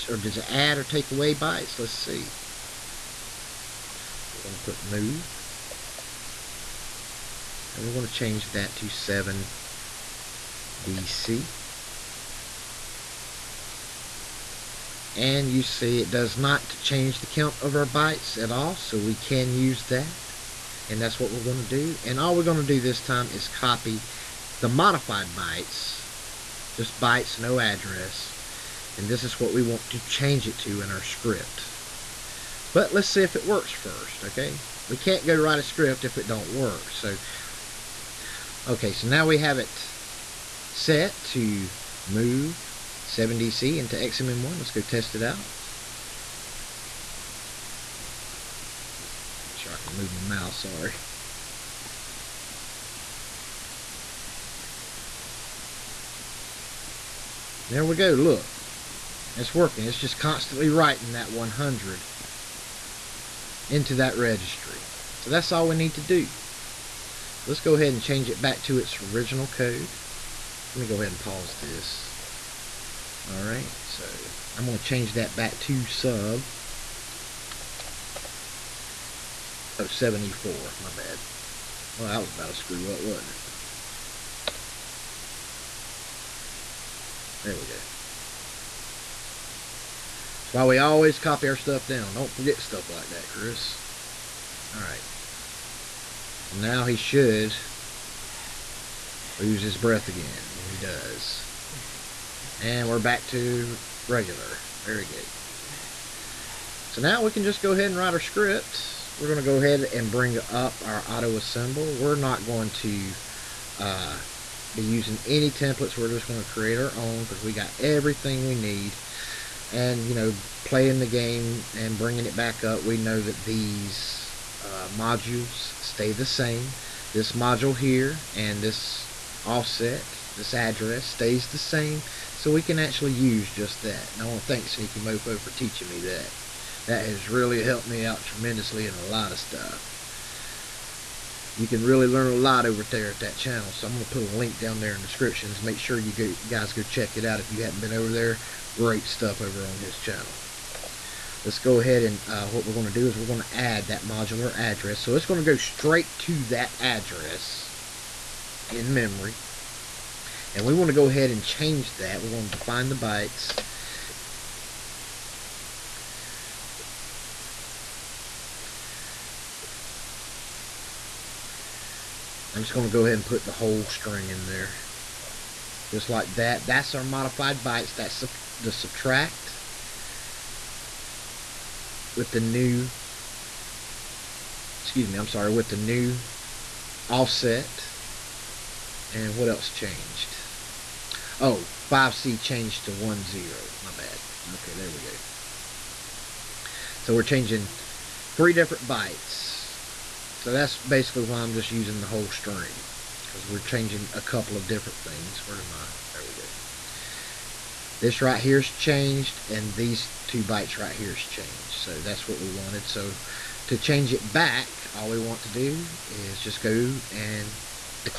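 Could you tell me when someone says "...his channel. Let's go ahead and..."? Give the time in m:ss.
2:29.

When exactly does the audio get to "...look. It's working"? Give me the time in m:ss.
0:58.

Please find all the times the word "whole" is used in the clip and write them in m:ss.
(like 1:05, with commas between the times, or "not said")
2:53, 3:22.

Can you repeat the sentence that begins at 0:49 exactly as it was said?
Make sure I can move my mouse, sorry.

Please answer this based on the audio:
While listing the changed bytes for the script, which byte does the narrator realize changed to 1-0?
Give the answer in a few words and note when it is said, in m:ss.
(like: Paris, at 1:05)
5C, at 3:11.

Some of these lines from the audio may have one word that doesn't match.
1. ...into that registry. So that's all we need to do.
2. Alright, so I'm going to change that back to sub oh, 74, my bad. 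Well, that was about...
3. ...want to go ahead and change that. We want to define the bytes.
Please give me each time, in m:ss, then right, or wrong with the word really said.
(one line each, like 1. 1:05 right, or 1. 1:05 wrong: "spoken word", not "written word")
1. 1:03 right
2. 1:13 right
3. 2:40 right.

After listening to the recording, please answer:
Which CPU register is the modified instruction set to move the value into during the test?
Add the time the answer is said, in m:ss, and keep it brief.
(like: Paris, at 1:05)
XMM1, at 0:43.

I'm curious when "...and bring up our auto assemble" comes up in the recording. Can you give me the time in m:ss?
1:49.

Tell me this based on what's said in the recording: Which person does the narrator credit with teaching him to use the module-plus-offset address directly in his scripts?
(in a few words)
Sneaky Mofo.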